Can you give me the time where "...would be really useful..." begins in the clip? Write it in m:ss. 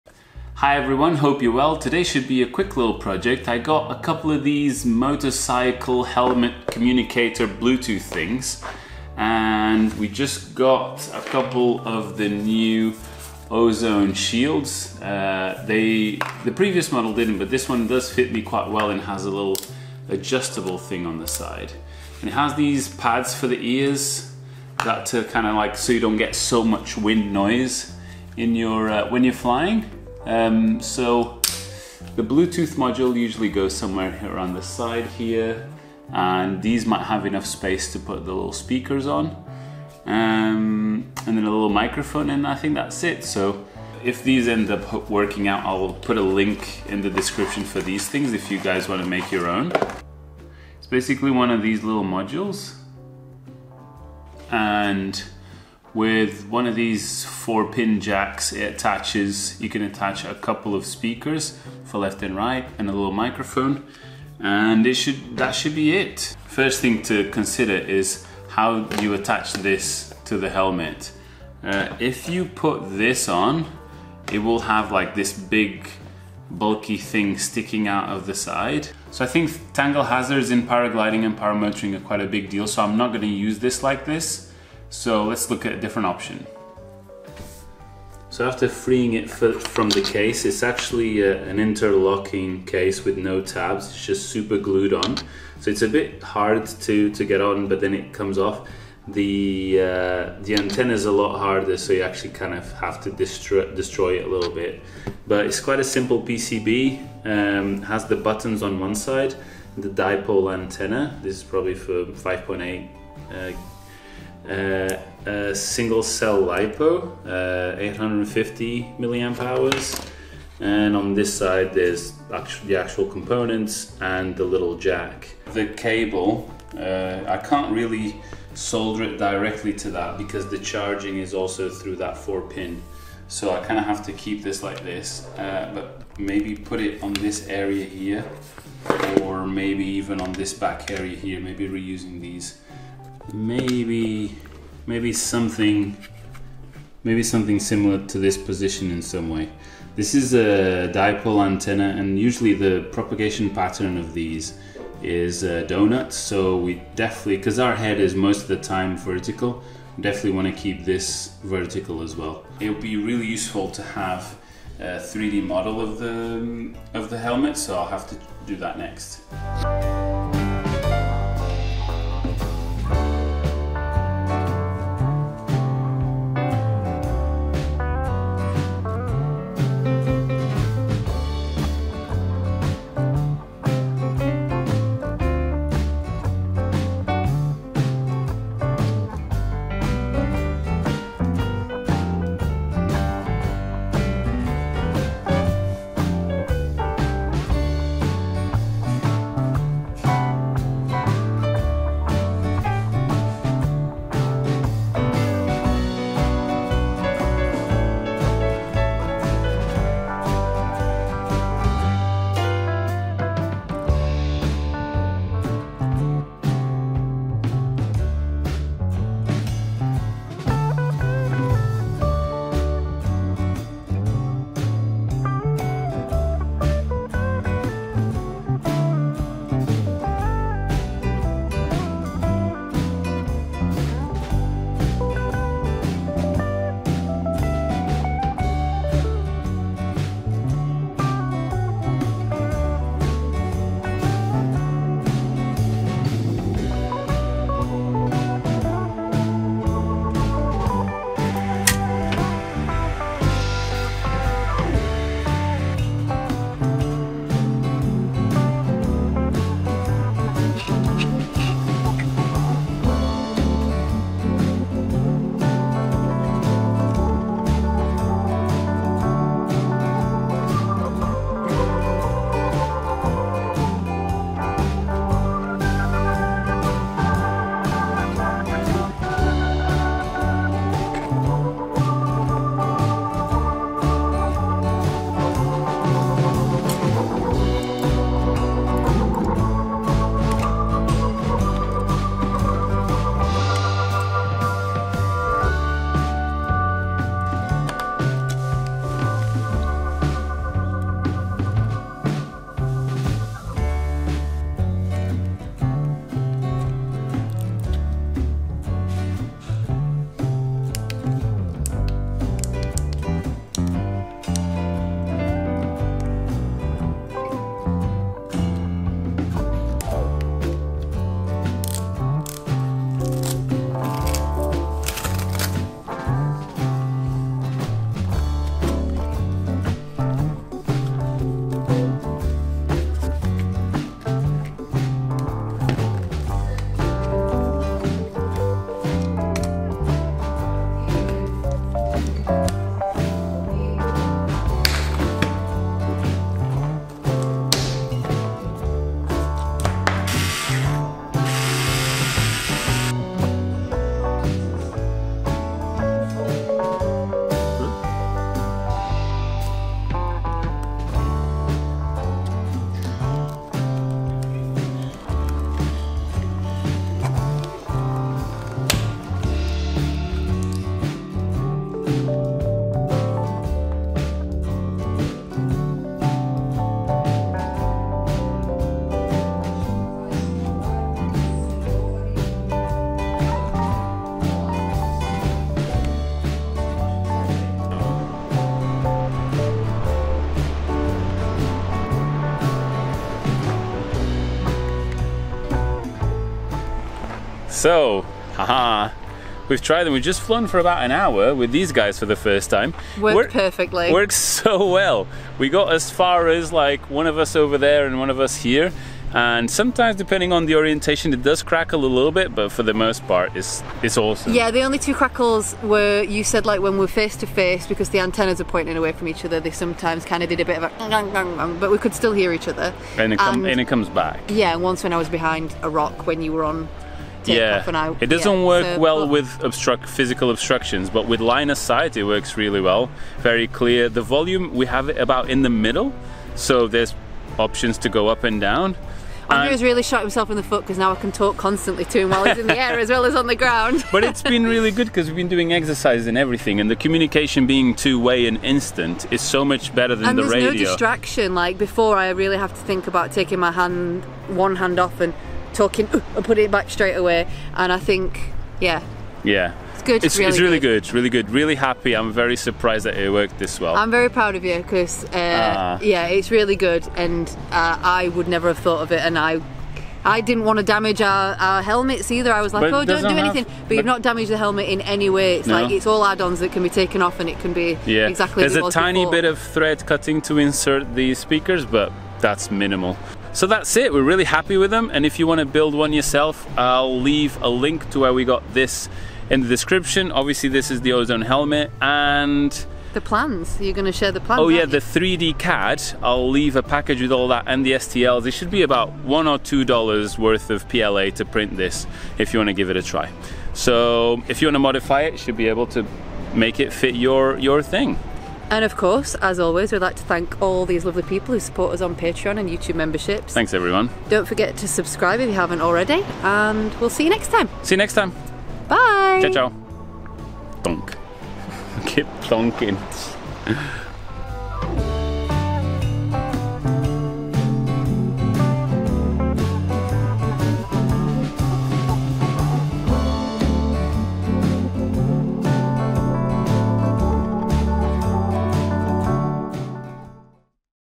2:42.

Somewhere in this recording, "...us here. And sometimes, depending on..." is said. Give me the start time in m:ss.
6:48.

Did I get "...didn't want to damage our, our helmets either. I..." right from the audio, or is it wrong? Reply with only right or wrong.
right.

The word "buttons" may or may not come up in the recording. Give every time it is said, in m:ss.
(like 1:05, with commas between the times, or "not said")
1:48.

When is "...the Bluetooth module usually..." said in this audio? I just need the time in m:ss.
0:32.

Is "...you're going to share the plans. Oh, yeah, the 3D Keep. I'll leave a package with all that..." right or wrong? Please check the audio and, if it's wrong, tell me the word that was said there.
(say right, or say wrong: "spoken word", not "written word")
wrong: "CAD", not "Keep".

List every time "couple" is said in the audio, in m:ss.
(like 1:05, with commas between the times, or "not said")
0:03, 0:11, 1:00.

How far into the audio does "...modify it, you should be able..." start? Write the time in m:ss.
8:24.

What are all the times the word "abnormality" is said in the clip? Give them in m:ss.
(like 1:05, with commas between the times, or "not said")
not said.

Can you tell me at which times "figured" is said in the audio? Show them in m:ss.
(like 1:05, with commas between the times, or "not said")
not said.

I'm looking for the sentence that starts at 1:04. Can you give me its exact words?
And it should that should be it.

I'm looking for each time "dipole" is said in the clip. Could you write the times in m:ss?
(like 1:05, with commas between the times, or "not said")
1:49, 2:30.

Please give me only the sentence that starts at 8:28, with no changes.
And of course, as always, we'd like to thank all these lovely people who support us on Patreon and YouTube memberships.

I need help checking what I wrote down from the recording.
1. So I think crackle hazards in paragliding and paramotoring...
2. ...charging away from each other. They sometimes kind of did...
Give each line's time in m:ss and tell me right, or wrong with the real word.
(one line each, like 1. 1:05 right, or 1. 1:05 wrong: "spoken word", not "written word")
1. 1:19 wrong: "tangle", not "crackle"
2. 6:58 wrong: "pointing", not "charging".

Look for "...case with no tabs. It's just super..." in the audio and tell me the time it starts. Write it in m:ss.
1:32.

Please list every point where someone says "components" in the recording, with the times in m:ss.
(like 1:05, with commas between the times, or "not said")
2:03.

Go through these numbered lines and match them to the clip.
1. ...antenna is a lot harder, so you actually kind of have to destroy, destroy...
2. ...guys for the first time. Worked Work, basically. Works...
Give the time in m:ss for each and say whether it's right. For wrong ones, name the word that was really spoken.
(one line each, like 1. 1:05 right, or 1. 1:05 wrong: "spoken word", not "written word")
1. 1:40 right
2. 6:41 wrong: "perfectly", not "basically".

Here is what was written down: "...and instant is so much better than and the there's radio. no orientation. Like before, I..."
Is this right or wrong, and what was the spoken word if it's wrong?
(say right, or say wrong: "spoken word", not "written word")
wrong: "distraction", not "orientation".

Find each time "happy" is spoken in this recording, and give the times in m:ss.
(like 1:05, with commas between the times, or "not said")
7:41, 8:04.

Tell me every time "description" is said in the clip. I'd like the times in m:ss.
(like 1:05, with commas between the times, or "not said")
0:47, 8:09.